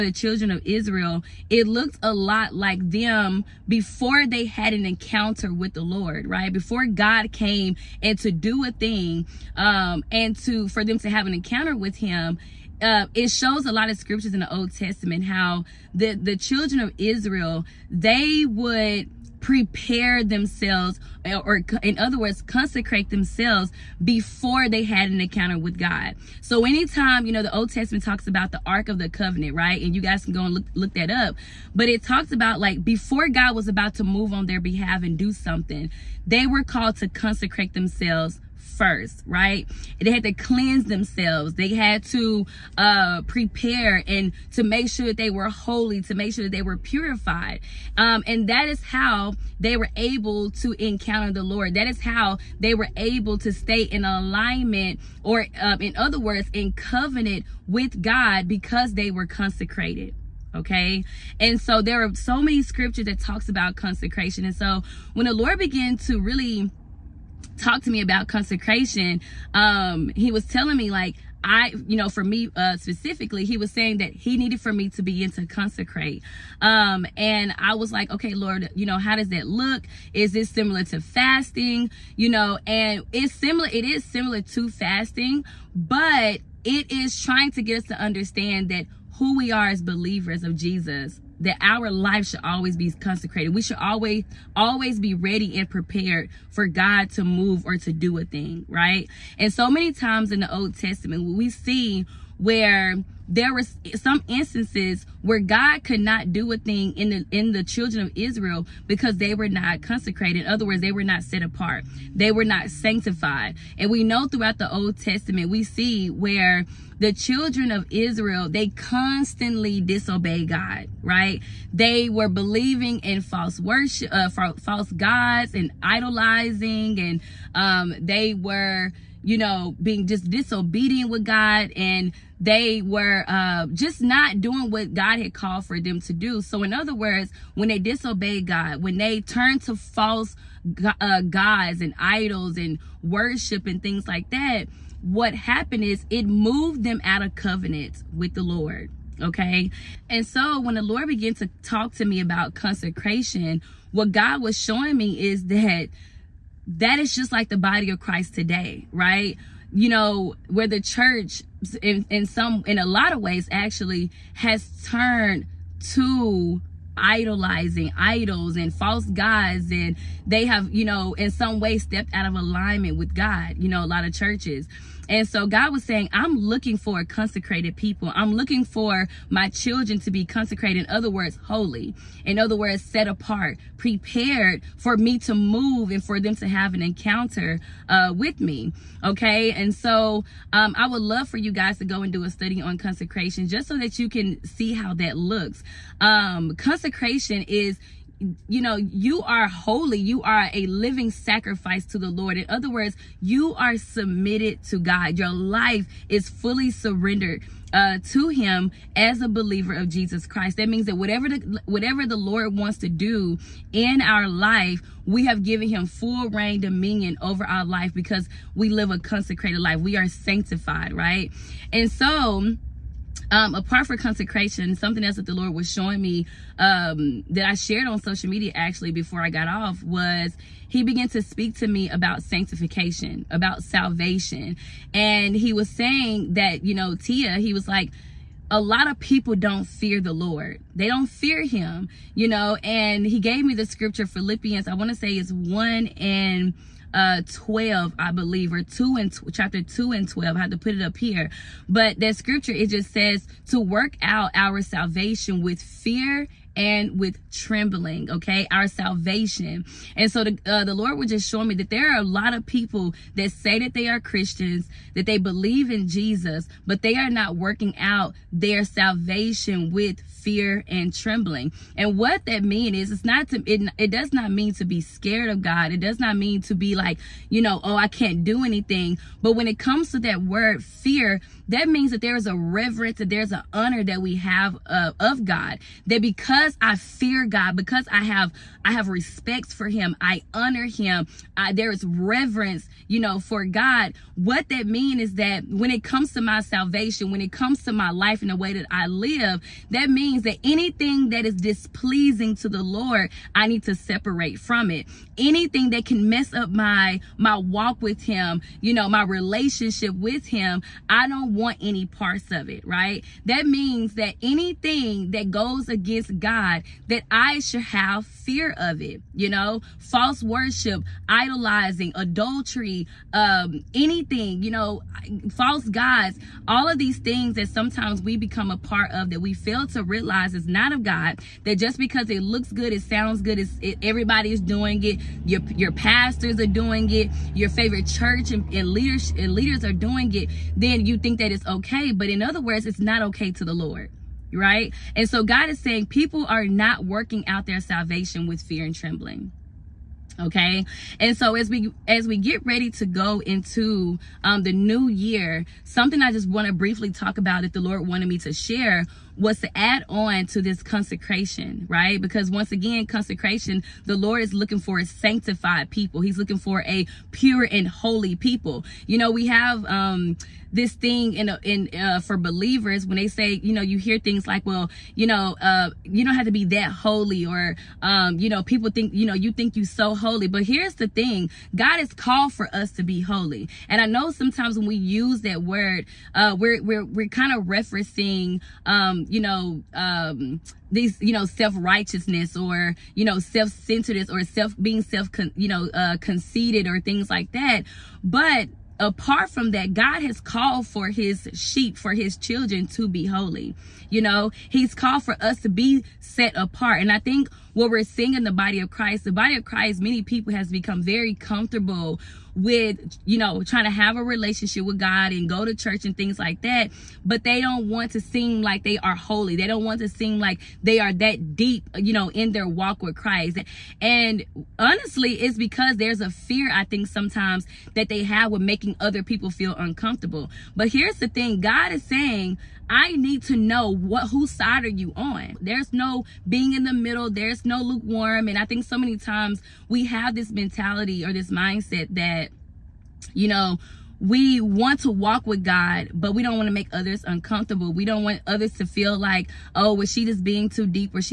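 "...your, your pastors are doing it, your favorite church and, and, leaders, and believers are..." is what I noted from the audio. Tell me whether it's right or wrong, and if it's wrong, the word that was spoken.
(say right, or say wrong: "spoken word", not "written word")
wrong: "leaders", not "believers".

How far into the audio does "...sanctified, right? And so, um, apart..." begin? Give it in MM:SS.
03:40.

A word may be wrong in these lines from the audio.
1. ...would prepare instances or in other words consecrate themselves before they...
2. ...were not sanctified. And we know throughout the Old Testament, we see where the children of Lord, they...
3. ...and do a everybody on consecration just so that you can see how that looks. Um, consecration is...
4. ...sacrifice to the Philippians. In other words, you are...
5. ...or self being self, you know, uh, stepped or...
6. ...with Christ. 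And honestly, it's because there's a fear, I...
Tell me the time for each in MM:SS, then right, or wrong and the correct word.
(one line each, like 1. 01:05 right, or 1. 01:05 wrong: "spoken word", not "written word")
1. 00:18 wrong: "themselves", not "instances"
2. 01:52 wrong: "Israel", not "Lord"
3. 03:12 wrong: "study", not "everybody"
4. 03:21 wrong: "Lord", not "Philippians"
5. 06:34 wrong: "conceited", not "stepped"
6. 07:02 right.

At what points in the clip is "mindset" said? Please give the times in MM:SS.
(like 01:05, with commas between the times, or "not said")
07:21.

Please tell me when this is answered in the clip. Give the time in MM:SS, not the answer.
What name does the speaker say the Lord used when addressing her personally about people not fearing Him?
03:56.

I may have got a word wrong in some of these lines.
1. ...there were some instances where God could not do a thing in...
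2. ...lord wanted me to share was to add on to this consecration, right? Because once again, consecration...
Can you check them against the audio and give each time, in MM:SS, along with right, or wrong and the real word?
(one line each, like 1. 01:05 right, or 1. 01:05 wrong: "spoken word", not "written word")
1. 01:43 right
2. 05:57 right.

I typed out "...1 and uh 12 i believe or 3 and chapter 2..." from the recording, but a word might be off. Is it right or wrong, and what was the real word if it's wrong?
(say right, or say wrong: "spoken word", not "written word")
wrong: "2", not "3".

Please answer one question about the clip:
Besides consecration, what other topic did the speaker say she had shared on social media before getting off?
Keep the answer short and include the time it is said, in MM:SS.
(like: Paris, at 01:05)
Sanctification, at 03:52.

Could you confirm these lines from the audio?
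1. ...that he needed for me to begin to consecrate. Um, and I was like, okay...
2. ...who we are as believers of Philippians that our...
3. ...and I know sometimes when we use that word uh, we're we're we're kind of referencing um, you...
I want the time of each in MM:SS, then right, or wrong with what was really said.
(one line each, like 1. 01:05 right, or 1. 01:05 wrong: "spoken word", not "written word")
1. 01:13 right
2. 01:29 wrong: "Jesus", not "Philippians"
3. 06:23 right.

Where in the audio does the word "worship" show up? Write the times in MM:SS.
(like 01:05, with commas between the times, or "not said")
02:03, 02:23, 05:20.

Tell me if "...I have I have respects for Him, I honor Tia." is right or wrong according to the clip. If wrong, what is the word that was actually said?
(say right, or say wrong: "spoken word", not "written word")
wrong: "Him", not "Tia".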